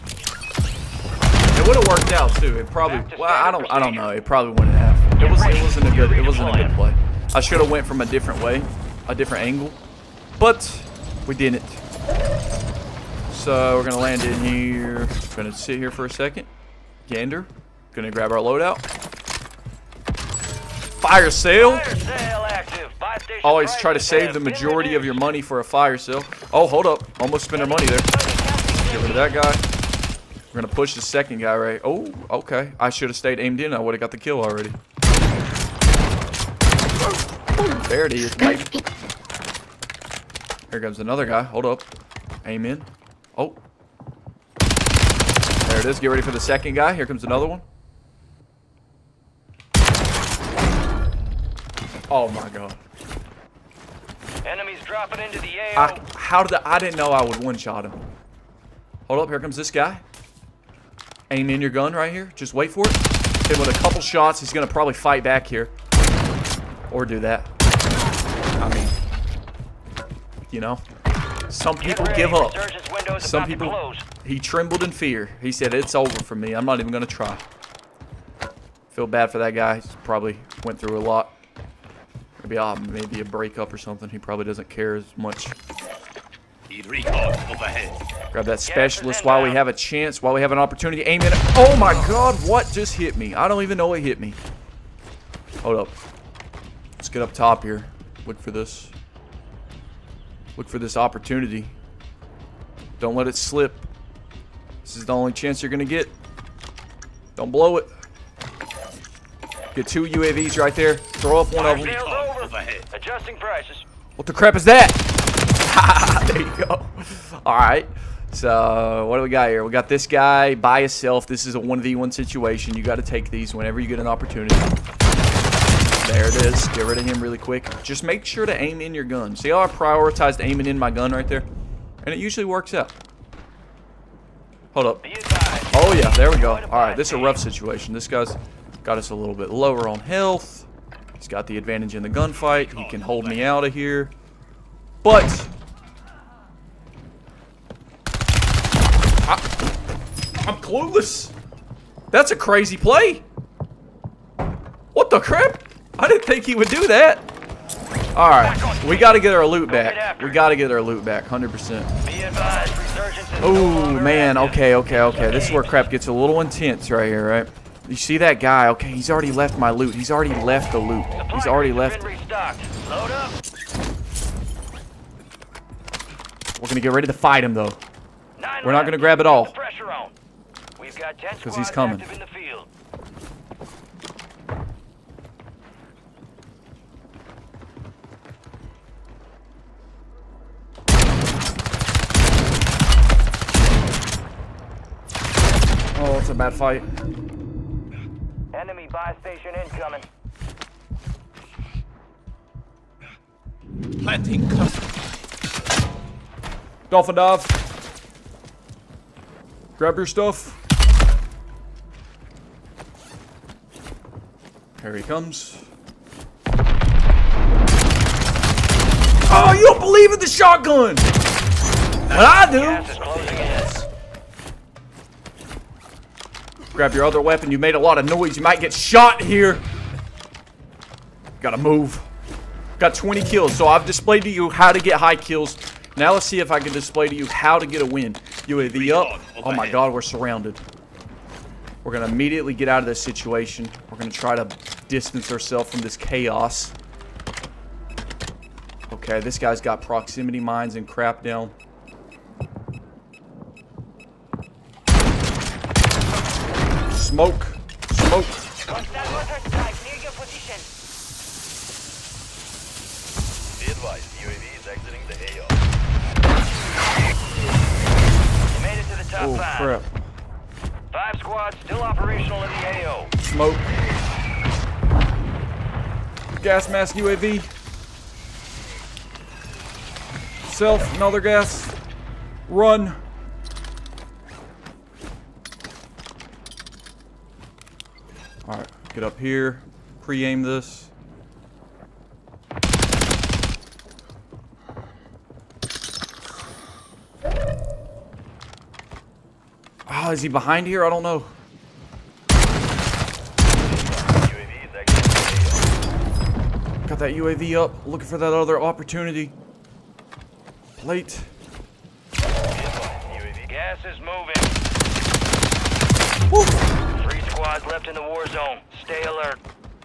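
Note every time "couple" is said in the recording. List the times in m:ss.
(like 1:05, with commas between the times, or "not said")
1:03.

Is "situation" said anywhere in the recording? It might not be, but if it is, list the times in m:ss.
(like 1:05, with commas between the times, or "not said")
2:02, 2:17, 4:03.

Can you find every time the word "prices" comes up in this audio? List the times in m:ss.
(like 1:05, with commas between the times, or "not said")
1:53.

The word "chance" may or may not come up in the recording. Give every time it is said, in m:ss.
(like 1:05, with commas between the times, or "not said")
1:29, 1:45.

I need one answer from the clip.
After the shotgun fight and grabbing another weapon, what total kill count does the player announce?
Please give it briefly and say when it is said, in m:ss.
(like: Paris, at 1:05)
20, at 3:52.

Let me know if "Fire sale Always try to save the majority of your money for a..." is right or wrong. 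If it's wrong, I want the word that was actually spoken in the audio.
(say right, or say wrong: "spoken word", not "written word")
right.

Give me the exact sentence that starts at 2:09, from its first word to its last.
See how I prioritized aiming in my gun right there?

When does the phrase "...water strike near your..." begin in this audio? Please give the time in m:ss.
4:18.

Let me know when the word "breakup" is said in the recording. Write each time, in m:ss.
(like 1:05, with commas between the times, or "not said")
1:23.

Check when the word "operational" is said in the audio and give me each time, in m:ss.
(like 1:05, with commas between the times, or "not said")
4:31.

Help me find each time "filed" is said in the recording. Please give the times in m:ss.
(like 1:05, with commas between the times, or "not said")
not said.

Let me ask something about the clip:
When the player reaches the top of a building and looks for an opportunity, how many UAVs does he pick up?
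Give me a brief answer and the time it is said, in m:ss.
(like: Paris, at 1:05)
2, at 1:49.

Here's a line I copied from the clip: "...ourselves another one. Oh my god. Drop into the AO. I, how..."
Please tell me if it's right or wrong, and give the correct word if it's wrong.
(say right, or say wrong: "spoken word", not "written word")
wrong: "comes", not "ourselves".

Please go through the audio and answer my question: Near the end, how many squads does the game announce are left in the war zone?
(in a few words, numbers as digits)
3.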